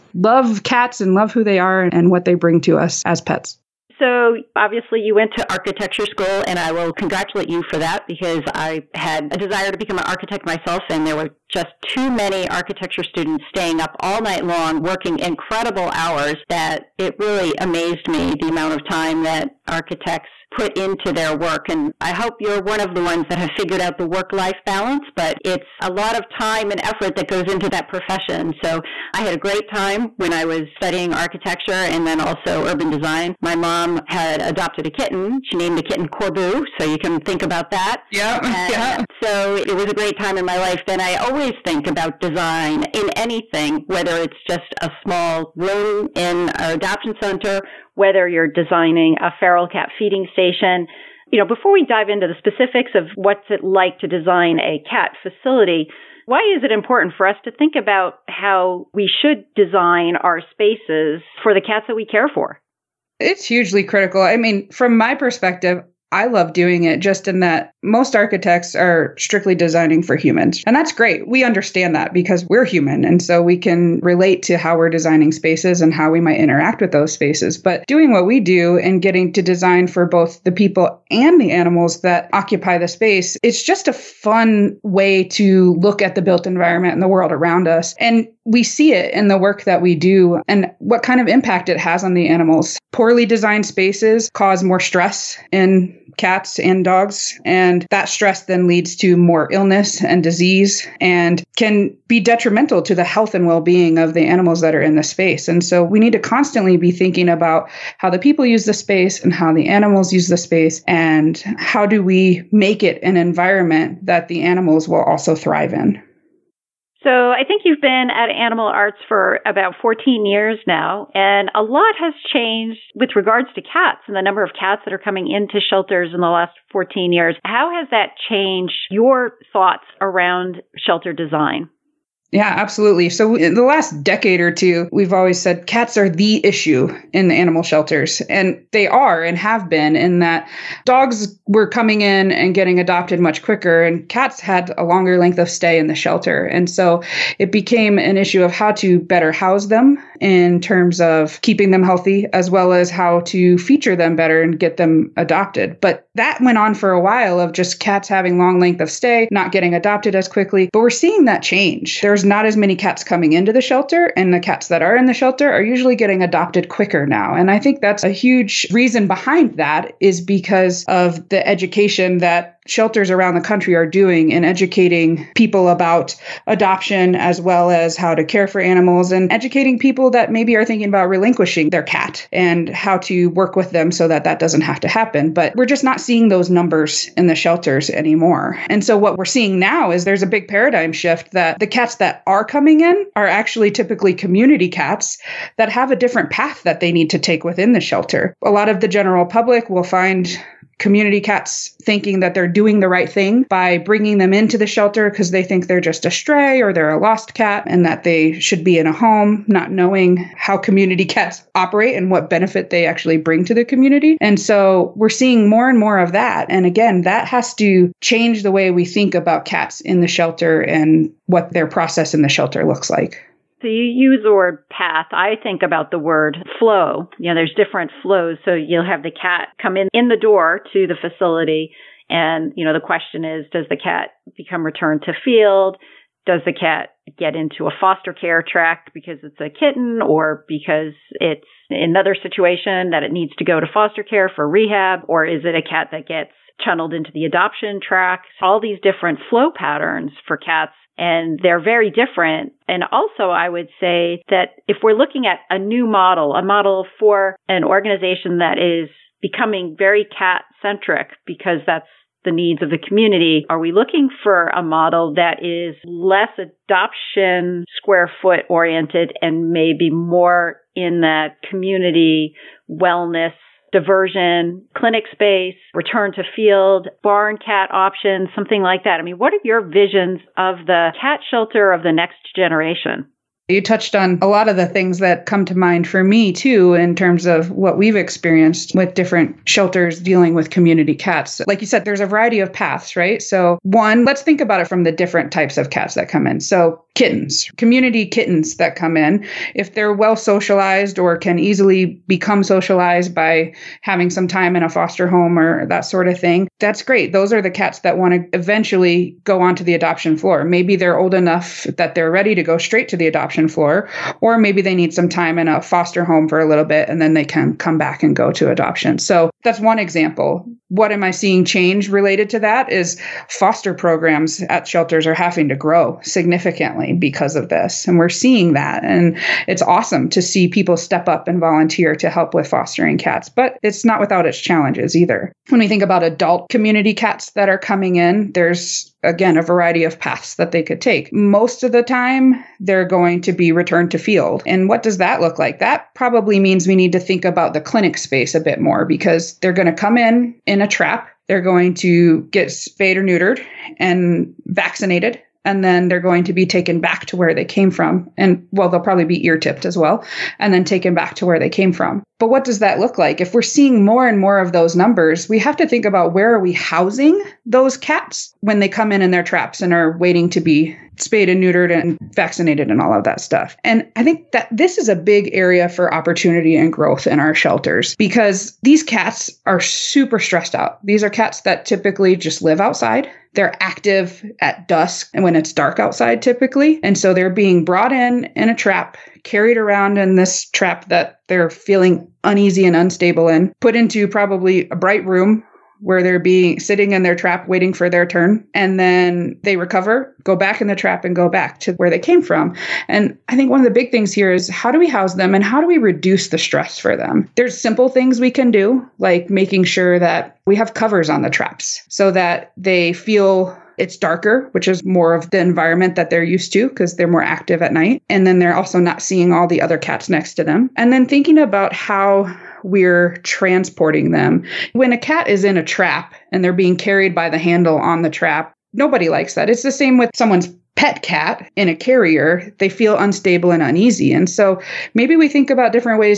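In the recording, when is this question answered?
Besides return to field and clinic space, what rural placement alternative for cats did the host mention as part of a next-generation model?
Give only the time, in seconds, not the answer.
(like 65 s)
277 s.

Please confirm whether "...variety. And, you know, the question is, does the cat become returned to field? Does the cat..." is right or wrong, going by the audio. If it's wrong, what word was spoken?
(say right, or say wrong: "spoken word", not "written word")
wrong: "facility", not "variety".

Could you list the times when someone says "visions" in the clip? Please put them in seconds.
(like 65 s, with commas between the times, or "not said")
279 s.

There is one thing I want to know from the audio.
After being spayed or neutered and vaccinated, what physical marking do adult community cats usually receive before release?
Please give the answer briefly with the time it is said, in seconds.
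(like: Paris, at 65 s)
ear tipped, at 359 s.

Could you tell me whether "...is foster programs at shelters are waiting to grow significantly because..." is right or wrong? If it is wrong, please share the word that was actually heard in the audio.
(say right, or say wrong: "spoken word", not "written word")
wrong: "having", not "waiting".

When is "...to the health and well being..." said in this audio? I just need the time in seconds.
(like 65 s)
102 s.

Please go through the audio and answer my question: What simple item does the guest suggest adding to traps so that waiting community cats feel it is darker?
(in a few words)
covers.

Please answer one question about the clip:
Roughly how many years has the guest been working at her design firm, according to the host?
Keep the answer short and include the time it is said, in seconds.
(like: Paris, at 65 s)
14, at 119 s.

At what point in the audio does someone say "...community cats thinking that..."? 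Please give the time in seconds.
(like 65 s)
200 s.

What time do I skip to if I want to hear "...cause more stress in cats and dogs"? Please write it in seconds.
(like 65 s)
94 s.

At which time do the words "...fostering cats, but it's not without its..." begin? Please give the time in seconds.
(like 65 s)
332 s.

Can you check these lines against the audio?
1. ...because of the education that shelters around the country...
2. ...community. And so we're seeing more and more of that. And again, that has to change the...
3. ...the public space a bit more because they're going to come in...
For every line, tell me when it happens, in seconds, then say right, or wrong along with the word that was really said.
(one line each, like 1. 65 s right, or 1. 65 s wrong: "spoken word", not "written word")
1. 170 s right
2. 213 s right
3. 347 s wrong: "clinic", not "public".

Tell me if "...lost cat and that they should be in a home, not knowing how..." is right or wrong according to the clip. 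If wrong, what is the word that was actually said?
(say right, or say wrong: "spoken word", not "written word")
right.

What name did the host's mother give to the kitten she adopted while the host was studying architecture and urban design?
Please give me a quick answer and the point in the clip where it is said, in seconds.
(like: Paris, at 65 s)
Corbu, at 36 s.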